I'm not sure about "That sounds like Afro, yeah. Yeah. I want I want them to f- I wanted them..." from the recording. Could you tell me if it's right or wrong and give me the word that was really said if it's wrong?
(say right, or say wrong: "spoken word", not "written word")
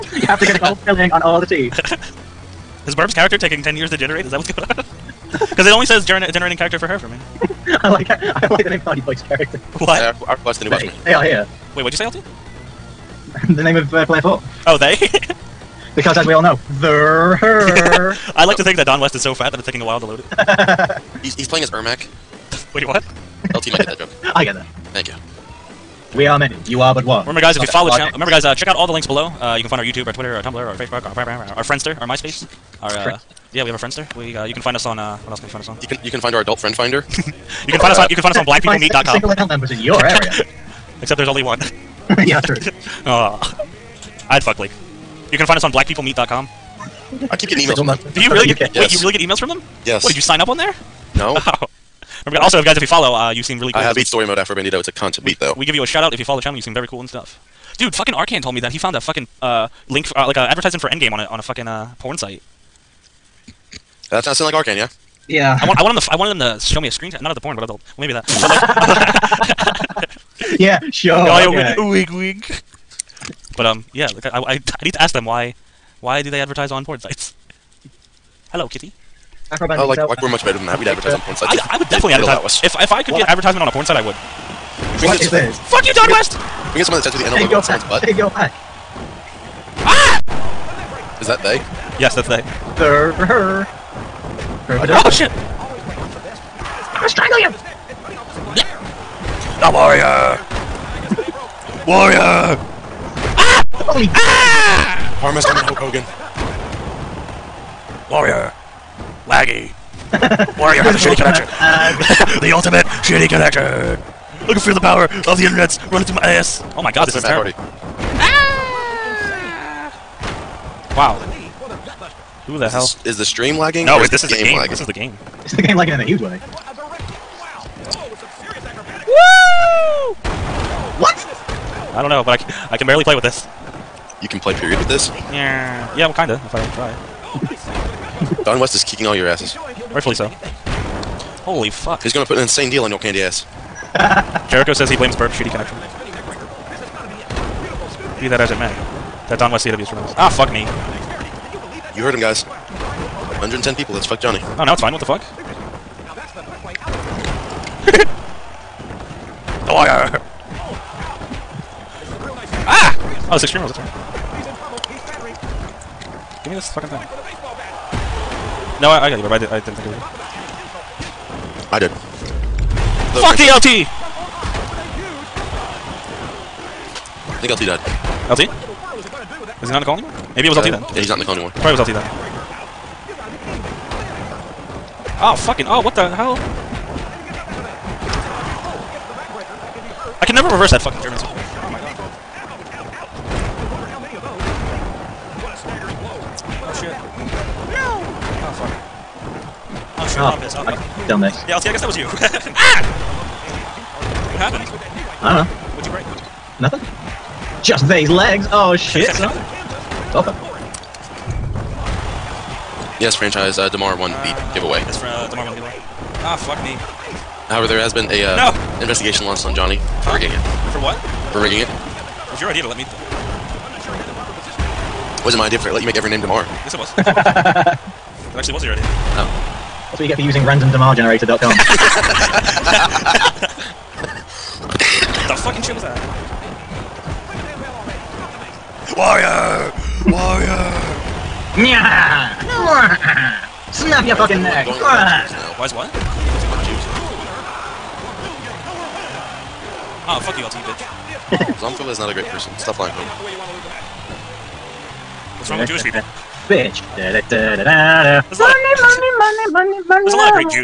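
wrong: "Arcan", not "Afro".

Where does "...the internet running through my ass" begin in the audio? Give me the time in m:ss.
1:55.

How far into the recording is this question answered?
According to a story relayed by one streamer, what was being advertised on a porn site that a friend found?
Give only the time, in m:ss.
1:00.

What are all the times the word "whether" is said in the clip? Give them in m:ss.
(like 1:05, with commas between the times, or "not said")
not said.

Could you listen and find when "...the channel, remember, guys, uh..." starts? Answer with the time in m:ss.
0:27.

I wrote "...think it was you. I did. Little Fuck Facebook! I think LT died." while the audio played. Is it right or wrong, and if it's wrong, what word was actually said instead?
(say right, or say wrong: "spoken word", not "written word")
wrong: "DLT", not "Facebook".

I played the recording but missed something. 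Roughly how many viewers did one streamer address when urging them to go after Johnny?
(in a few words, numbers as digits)
110.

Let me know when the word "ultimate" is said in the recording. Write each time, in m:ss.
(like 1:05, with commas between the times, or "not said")
1:52.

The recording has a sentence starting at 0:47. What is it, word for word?
I keep getting emails Single from them.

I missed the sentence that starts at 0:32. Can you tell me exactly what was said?
Uh, yeah, we have a friendster.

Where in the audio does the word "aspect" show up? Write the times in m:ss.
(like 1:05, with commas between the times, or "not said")
not said.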